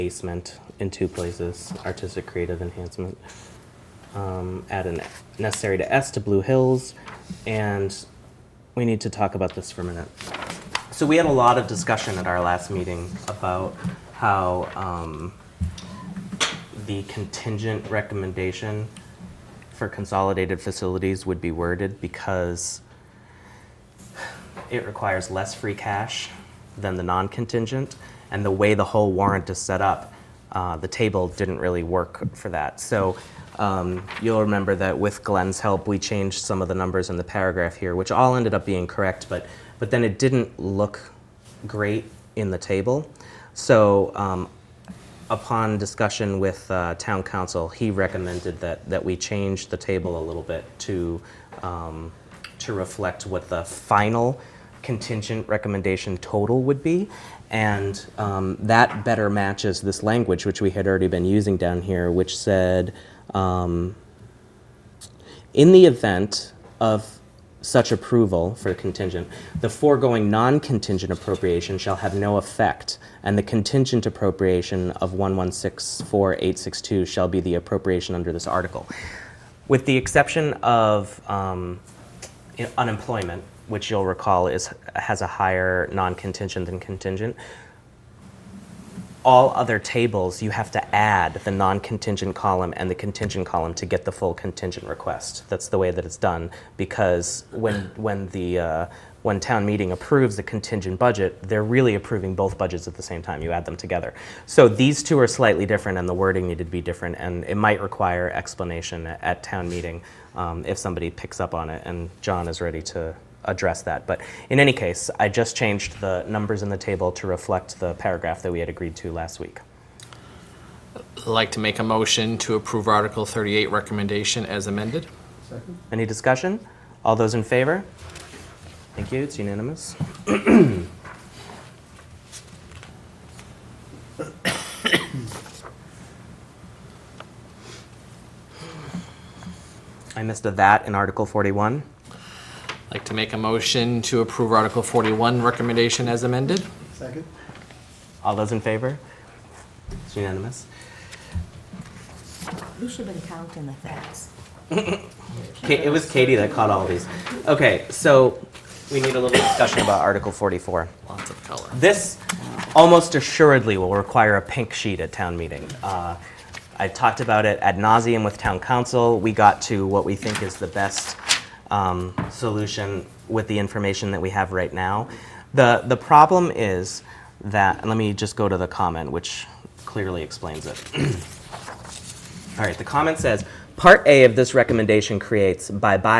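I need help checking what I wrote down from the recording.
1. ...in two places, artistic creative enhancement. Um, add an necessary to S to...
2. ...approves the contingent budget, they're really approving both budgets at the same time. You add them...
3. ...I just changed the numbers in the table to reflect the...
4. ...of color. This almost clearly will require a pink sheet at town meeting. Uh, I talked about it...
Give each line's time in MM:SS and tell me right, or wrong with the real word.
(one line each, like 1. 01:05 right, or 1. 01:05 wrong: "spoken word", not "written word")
1. 00:00 right
2. 01:39 right
3. 01:55 right
4. 02:41 wrong: "assuredly", not "clearly".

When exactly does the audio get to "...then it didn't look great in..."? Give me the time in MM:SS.
00:39.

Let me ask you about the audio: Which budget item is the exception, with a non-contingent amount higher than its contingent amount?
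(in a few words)
Unemployment.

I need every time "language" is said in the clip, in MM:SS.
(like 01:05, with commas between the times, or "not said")
01:00.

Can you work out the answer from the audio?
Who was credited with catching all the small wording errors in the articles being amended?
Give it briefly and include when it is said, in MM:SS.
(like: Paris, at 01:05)
Katie, at 02:36.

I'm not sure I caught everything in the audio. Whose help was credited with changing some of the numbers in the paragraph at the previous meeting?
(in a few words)
Glenn.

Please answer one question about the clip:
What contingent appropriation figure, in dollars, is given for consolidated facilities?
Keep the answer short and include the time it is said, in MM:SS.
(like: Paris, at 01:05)
1164862, at 01:15.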